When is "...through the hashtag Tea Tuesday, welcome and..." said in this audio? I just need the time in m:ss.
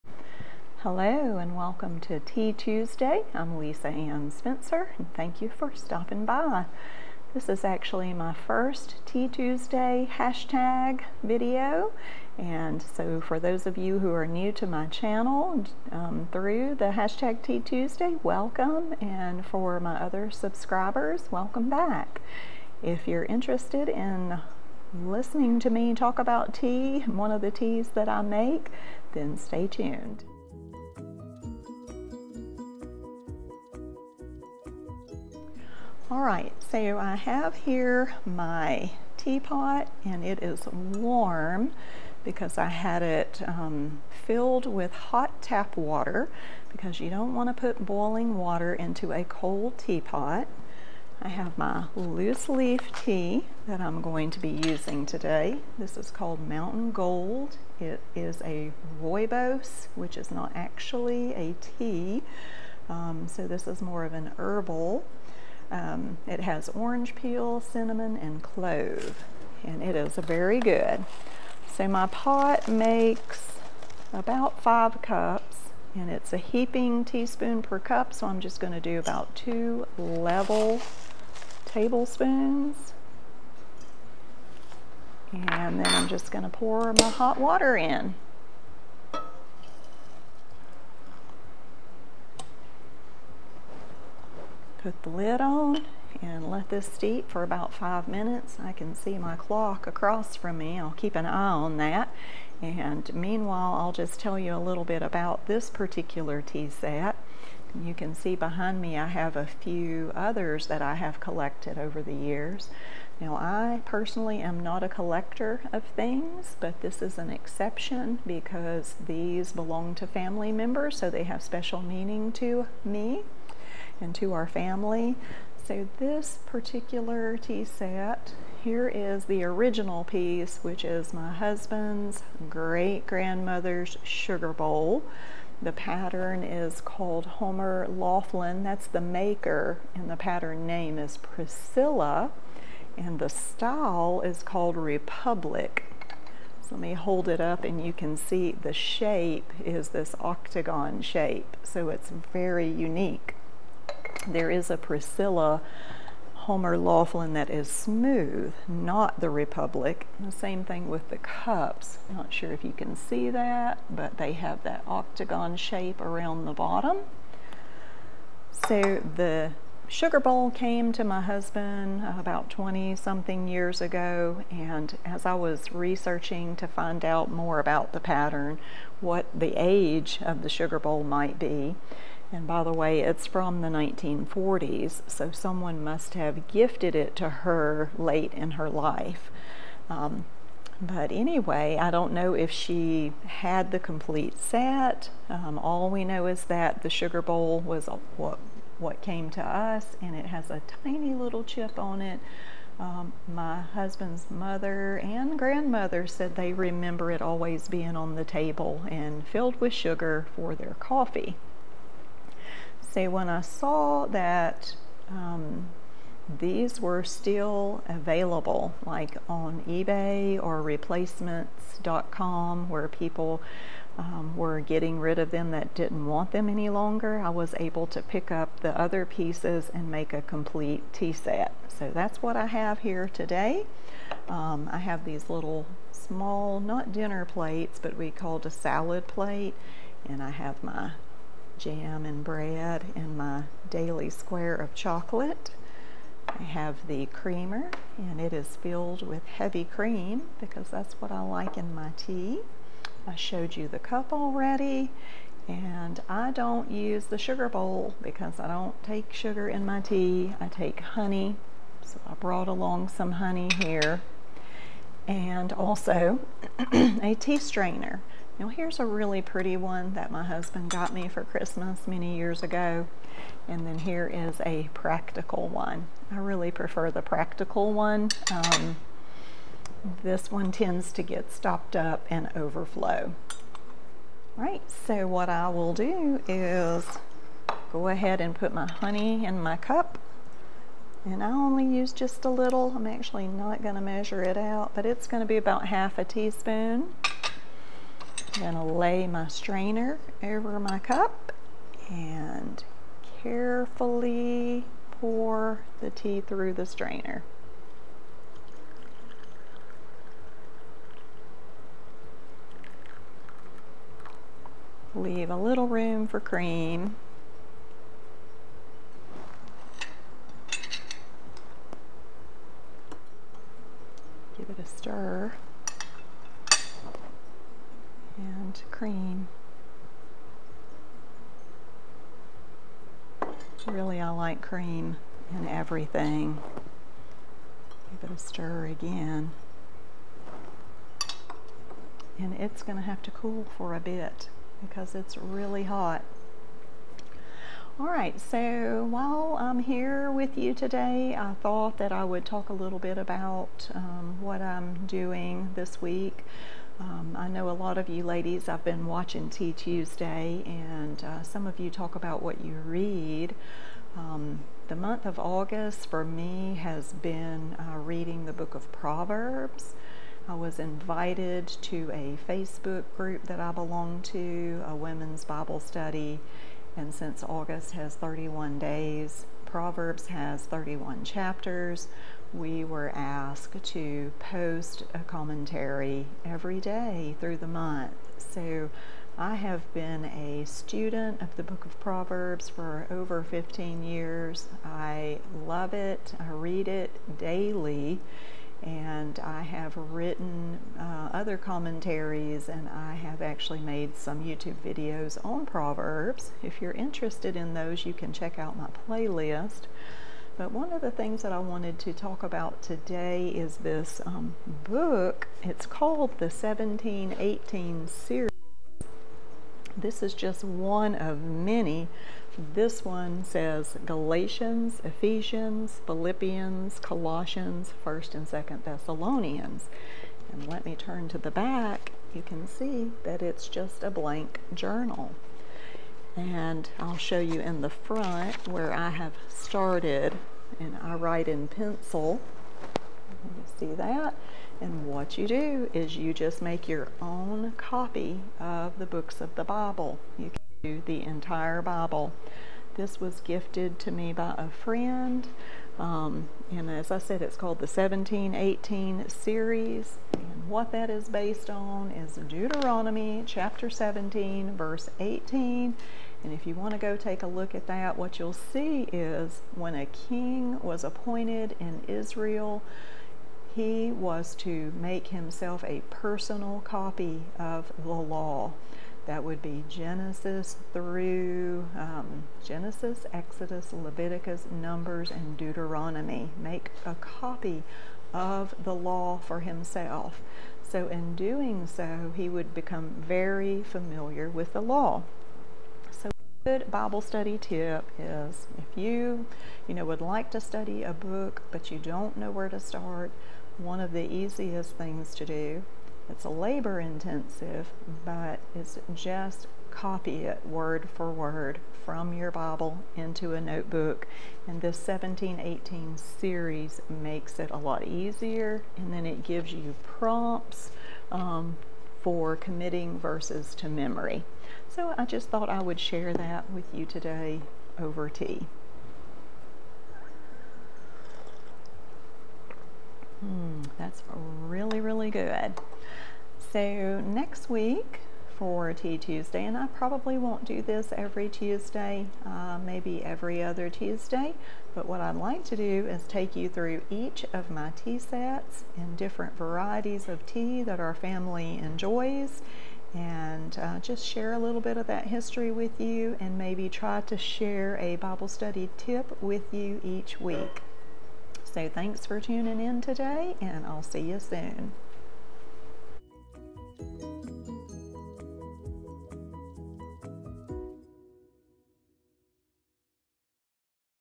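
0:16.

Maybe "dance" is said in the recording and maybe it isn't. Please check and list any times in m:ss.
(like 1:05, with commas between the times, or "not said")
not said.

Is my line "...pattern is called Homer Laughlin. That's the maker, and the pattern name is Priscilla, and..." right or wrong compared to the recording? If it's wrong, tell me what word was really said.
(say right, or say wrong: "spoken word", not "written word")
right.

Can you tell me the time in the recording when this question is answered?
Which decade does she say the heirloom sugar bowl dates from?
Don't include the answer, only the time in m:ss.
3:03.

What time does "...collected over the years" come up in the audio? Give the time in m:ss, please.
1:51.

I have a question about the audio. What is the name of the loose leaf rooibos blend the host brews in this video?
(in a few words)
Mountain Gold.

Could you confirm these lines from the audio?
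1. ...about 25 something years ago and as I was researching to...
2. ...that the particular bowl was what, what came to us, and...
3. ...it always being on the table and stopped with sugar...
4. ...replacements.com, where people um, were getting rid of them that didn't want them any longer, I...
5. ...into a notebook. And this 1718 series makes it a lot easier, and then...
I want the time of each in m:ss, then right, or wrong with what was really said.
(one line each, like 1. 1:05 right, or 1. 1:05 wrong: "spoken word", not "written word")
1. 2:52 wrong: "20", not "25"
2. 3:16 wrong: "sugar", not "particular"
3. 3:27 wrong: "filled", not "stopped"
4. 3:40 right
5. 8:32 right.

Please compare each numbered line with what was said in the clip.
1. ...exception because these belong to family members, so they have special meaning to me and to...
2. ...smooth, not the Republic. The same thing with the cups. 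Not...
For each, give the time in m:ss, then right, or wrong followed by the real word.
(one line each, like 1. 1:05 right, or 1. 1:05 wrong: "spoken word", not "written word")
1. 1:57 right
2. 2:37 right.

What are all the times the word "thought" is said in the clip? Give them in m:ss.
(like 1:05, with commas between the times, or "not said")
5:51, 8:45.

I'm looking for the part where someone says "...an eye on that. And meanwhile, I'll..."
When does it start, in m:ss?
1:41.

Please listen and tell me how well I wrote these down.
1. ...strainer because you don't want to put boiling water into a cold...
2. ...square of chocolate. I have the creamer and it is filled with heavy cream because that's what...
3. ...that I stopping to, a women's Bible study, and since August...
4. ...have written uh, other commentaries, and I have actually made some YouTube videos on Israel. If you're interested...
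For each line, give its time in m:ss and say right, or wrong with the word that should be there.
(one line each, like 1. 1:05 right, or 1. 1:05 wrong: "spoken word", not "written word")
1. 0:45 wrong: "water", not "strainer"
2. 4:04 right
3. 6:13 wrong: "belong", not "stopping"
4. 6:39 wrong: "Proverbs", not "Israel".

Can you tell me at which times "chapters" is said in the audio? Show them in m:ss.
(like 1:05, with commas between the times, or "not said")
6:21, 7:43.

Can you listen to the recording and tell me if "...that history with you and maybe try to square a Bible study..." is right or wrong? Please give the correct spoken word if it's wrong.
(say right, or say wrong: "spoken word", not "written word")
wrong: "share", not "square".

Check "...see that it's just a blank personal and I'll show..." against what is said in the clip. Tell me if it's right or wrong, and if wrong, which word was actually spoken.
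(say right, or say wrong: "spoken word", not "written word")
wrong: "journal", not "personal".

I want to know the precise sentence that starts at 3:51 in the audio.
So that's what I have here today.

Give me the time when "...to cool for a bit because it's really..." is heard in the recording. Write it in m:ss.
5:43.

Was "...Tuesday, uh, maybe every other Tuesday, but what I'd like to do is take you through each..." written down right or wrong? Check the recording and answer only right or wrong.
right.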